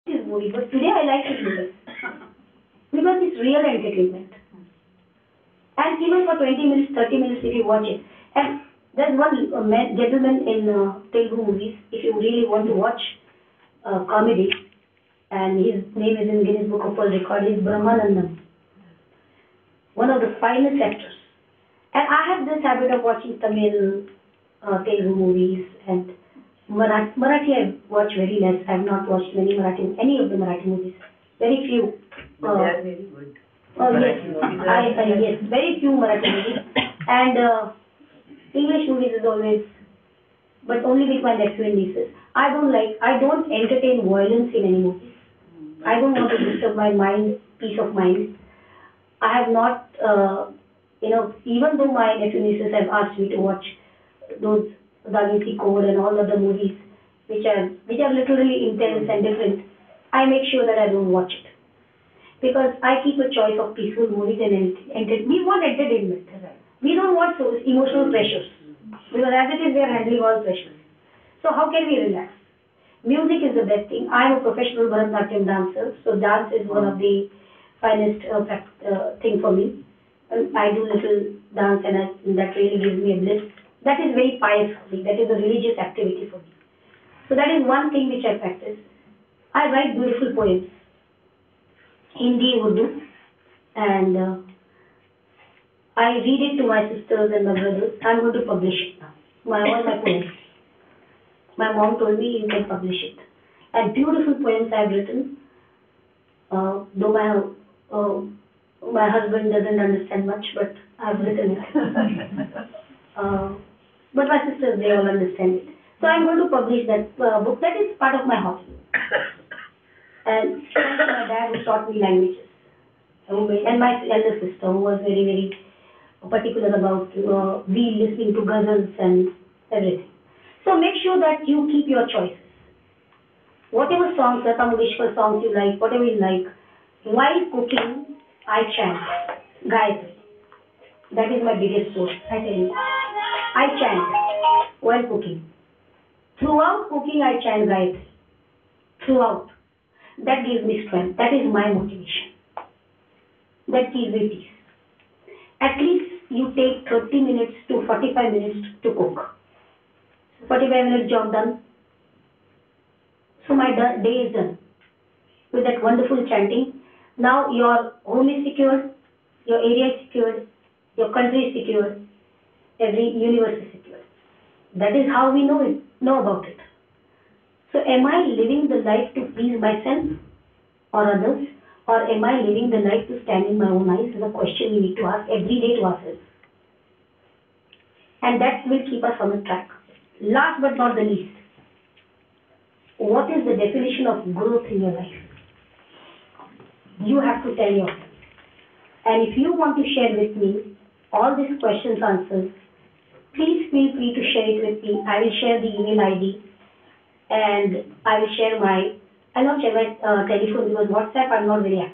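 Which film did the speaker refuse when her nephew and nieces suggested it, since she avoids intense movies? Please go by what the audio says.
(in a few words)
Da Vinci Code.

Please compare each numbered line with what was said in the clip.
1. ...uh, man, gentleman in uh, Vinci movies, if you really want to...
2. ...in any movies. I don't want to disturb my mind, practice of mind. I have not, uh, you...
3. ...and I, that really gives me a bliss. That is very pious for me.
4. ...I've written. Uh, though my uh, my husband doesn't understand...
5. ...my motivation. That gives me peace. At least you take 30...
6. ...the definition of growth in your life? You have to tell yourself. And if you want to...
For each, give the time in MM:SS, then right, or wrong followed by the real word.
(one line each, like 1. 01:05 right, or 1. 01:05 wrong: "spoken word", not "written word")
1. 00:09 wrong: "Telugu", not "Vinci"
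2. 00:44 wrong: "peace", not "practice"
3. 01:21 right
4. 01:44 right
5. 02:31 right
6. 03:13 right.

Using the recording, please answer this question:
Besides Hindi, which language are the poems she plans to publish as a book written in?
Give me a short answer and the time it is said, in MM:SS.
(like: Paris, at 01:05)
Urdu, at 01:32.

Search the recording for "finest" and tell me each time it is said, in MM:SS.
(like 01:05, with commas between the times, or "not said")
00:20, 01:17.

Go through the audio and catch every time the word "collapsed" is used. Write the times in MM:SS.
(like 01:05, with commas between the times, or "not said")
not said.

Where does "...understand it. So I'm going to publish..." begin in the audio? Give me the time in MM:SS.
01:55.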